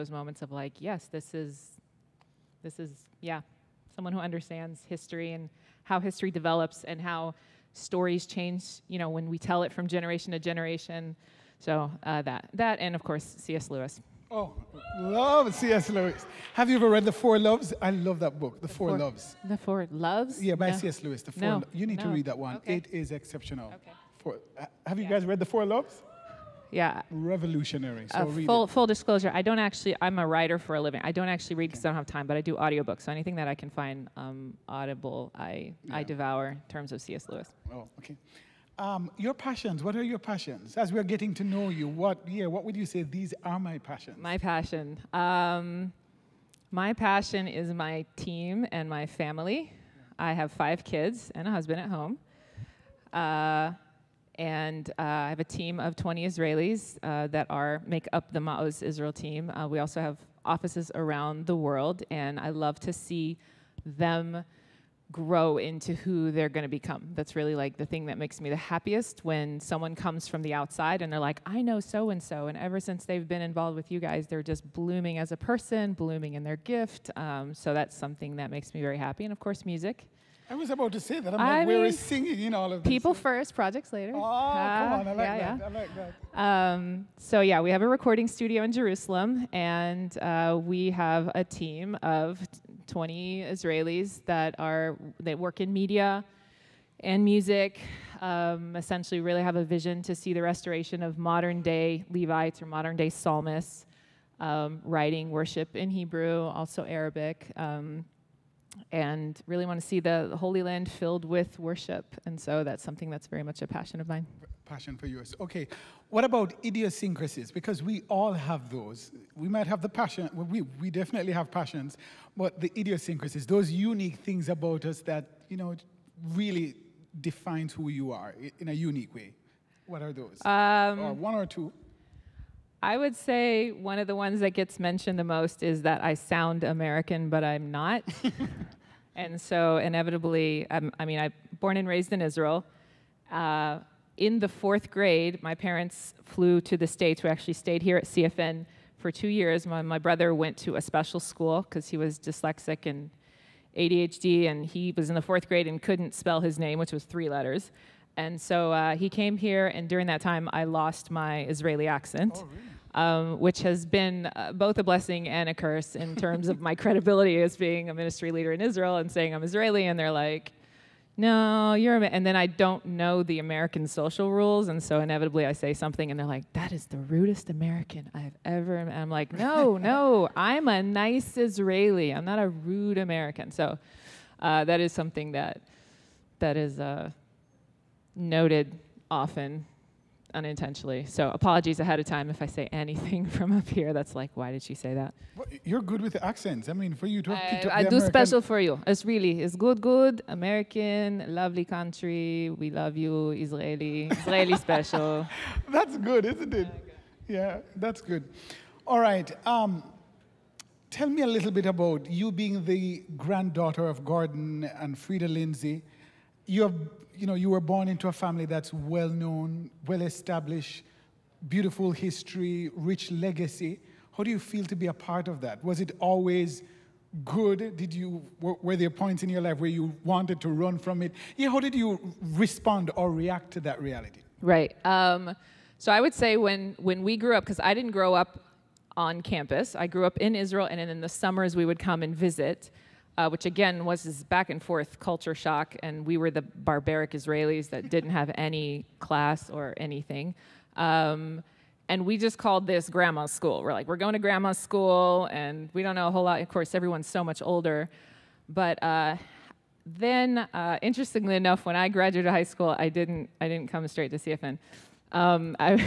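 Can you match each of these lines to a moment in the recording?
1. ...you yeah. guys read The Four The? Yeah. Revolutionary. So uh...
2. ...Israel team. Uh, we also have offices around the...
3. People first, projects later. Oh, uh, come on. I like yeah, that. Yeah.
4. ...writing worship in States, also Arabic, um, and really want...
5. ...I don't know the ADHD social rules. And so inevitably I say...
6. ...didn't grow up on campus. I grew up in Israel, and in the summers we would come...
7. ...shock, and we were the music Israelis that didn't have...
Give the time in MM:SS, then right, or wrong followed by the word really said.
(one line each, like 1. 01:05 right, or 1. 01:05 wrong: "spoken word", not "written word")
1. 00:24 wrong: "Loves", not "The"
2. 00:58 right
3. 01:22 right
4. 01:44 wrong: "Hebrew", not "States"
5. 02:52 wrong: "American", not "ADHD"
6. 03:57 right
7. 04:05 wrong: "barbaric", not "music".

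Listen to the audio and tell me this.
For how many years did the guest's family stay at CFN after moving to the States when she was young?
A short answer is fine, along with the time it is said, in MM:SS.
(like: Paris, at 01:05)
2, at 02:29.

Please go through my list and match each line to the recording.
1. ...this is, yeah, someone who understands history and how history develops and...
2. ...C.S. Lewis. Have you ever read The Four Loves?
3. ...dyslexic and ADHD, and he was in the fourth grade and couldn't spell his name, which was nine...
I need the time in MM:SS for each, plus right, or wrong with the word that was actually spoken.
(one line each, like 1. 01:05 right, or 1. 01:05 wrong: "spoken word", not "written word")
1. 00:02 right
2. 00:15 right
3. 02:32 wrong: "three", not "nine".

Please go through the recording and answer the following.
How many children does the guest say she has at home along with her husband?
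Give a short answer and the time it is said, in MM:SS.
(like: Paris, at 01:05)
5, at 00:50.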